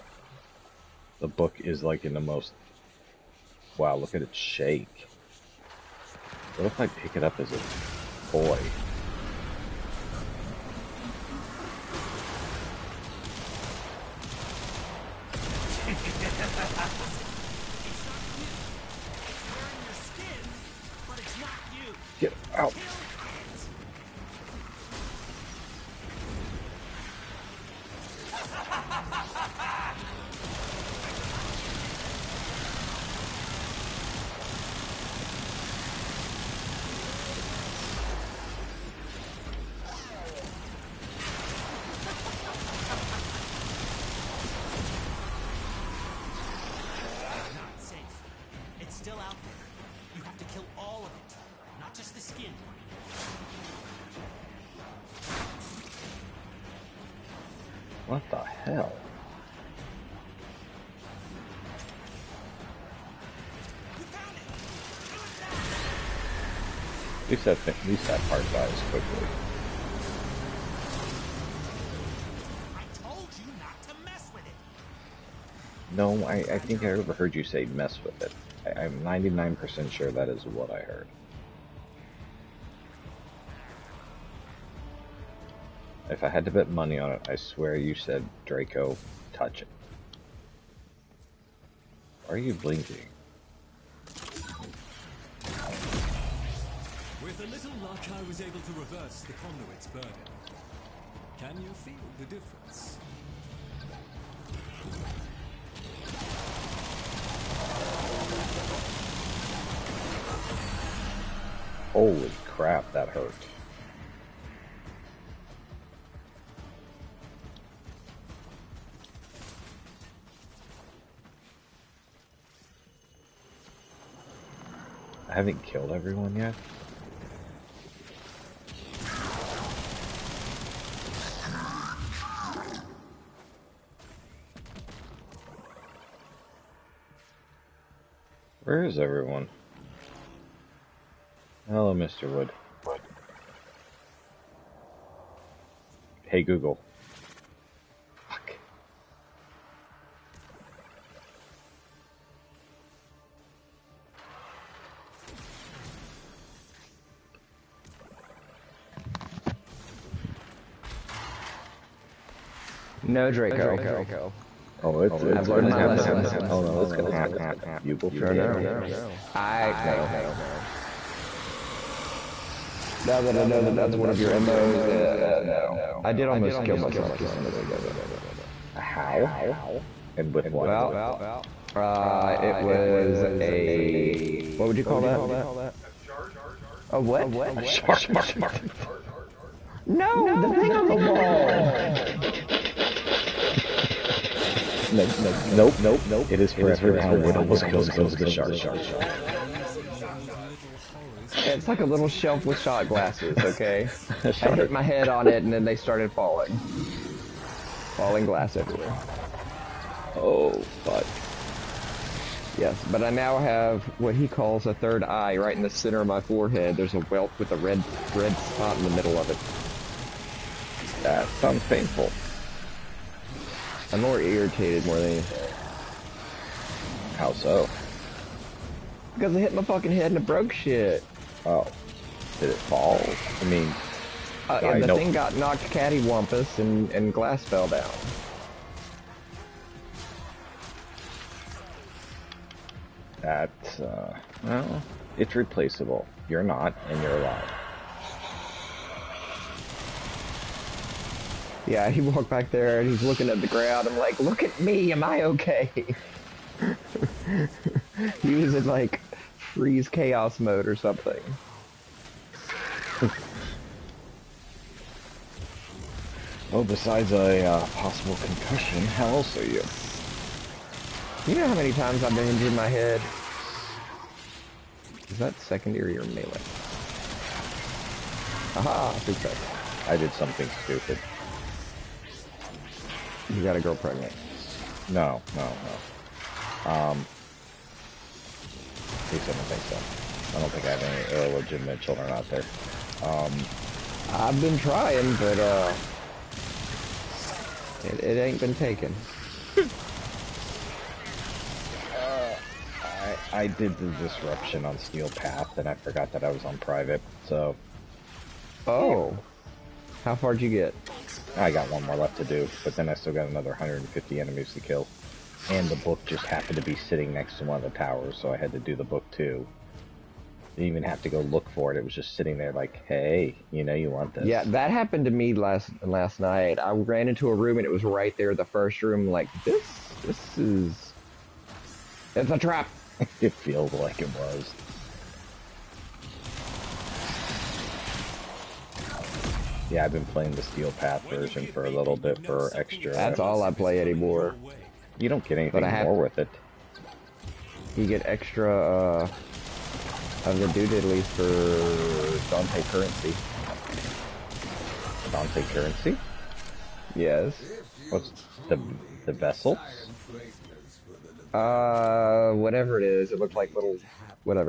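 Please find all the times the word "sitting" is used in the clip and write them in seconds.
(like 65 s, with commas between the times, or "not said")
316 s, 322 s.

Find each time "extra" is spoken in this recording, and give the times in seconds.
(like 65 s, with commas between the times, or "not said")
342 s, 348 s.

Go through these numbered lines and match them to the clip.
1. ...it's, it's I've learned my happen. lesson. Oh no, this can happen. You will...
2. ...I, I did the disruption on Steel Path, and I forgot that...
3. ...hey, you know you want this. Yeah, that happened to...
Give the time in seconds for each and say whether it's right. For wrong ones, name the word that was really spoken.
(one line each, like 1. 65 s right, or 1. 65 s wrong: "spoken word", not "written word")
1. 165 s right
2. 302 s right
3. 322 s right.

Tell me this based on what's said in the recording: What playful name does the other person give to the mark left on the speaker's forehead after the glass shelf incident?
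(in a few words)
Third eye.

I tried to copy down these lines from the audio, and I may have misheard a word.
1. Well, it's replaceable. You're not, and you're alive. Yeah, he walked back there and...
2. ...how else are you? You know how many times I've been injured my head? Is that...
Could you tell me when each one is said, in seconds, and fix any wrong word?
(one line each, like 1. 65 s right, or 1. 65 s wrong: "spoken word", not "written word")
1. 244 s right
2. 268 s right.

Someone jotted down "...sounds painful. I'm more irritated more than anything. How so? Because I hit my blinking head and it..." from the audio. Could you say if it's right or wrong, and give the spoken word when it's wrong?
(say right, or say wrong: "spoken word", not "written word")
wrong: "fucking", not "blinking".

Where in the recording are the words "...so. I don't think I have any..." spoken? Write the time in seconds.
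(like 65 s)
289 s.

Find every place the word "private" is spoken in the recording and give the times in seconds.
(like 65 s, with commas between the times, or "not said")
306 s.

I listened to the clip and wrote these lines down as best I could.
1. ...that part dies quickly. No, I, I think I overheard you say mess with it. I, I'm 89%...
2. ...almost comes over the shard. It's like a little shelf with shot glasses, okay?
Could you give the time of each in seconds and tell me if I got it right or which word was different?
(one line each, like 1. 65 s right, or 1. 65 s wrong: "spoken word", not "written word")
1. 68 s wrong: "99", not "89"
2. 197 s right.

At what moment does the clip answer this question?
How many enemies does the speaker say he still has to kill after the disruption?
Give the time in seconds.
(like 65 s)
313 s.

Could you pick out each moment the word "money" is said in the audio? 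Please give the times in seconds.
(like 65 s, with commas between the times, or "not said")
86 s.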